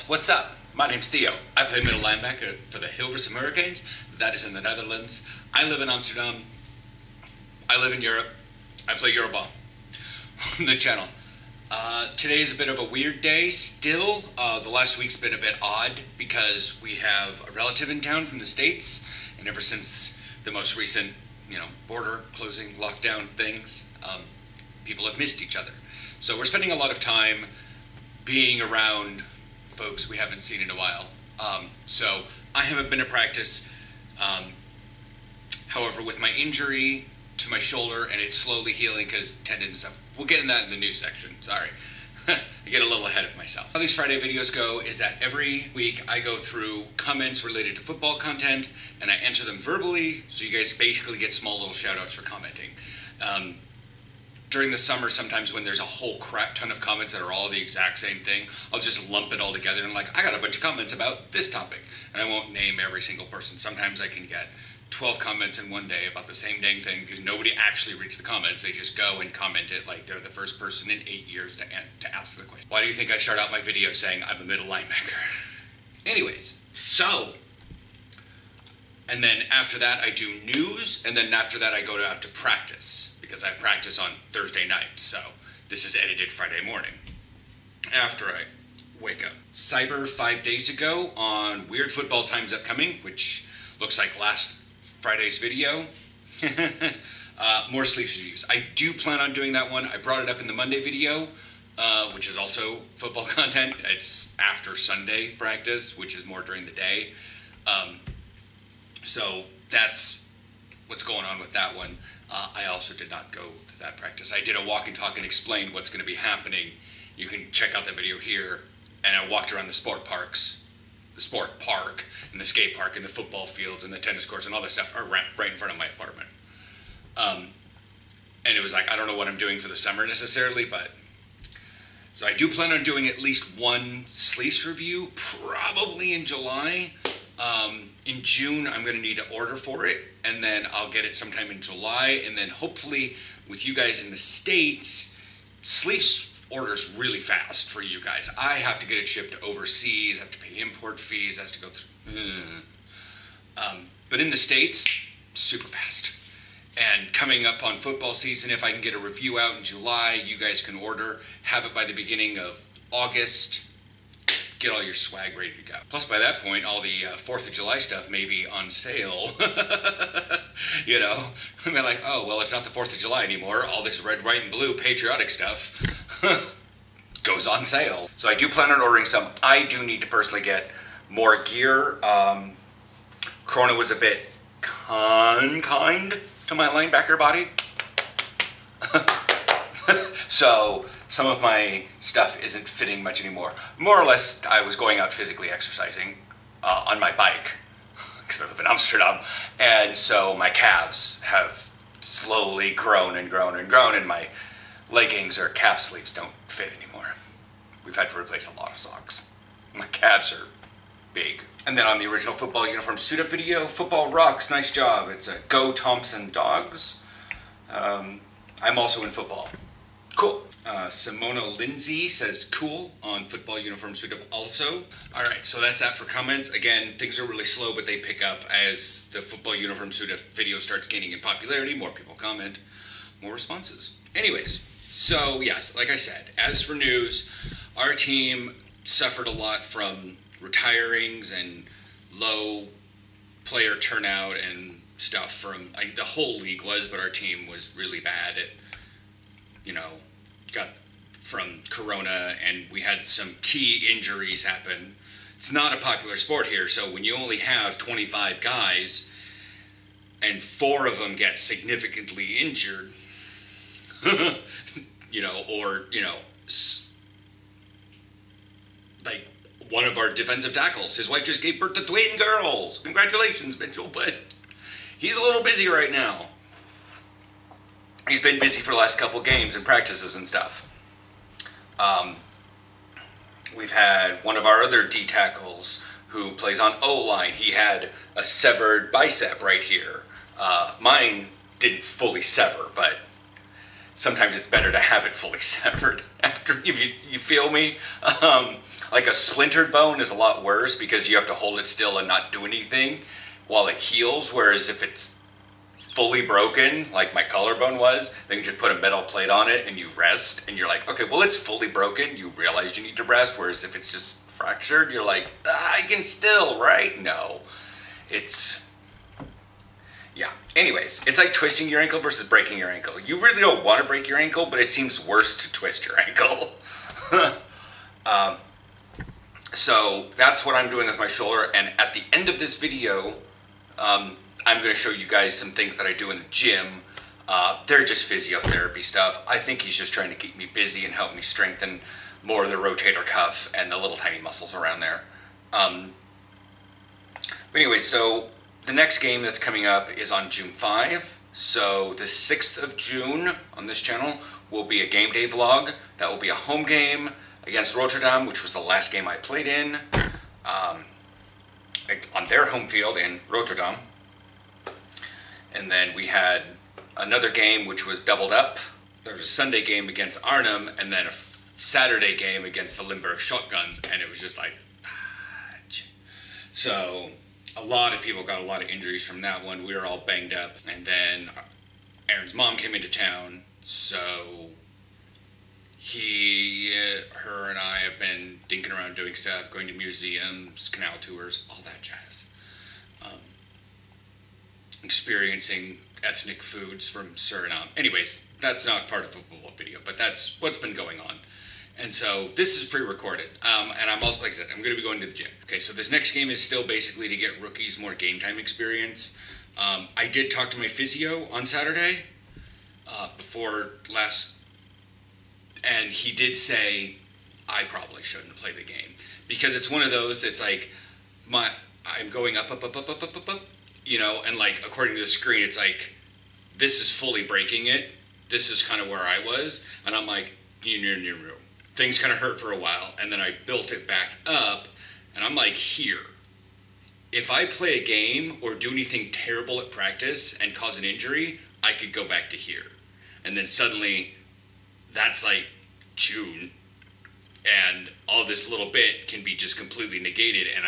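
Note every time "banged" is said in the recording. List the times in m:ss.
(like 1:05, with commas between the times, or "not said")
6:19.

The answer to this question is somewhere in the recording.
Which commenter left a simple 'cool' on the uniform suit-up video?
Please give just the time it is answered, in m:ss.
3:40.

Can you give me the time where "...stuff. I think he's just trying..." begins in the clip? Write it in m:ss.
5:38.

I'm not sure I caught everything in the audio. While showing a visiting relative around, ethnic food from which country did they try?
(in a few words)
Suriname.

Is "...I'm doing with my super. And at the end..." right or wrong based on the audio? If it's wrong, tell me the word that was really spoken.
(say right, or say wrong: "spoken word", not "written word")
wrong: "shoulder", not "super".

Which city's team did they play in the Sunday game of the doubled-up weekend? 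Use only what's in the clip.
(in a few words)
Arnhem.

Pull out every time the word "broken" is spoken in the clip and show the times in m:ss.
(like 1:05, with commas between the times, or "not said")
5:06, 5:11.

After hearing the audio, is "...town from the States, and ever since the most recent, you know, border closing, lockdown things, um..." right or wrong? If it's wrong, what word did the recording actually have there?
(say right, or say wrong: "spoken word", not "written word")
right.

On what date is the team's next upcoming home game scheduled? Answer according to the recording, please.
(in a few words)
June 5.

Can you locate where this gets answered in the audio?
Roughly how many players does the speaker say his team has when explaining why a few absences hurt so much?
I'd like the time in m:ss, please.
4:17.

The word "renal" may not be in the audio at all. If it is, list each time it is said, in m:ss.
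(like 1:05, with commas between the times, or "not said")
not said.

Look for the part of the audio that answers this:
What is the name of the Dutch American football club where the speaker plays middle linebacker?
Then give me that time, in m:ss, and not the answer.
0:02.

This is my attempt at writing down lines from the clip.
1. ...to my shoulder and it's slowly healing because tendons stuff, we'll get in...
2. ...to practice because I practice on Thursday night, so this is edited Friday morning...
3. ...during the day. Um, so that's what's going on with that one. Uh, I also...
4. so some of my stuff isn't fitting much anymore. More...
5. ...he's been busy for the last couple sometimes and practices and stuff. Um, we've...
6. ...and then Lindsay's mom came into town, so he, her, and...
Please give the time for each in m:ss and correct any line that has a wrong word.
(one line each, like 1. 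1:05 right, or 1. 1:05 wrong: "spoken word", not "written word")
1. 0:37 right
2. 1:22 right
3. 1:46 right
4. 3:10 right
5. 4:38 wrong: "games", not "sometimes"
6. 6:20 wrong: "Aaron", not "Lindsay".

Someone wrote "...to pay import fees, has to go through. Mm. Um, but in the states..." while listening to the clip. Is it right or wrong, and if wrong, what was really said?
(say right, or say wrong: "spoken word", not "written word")
right.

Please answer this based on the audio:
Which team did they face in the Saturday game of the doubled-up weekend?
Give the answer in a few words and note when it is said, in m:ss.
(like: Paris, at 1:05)
Limburg Shotguns, at 6:12.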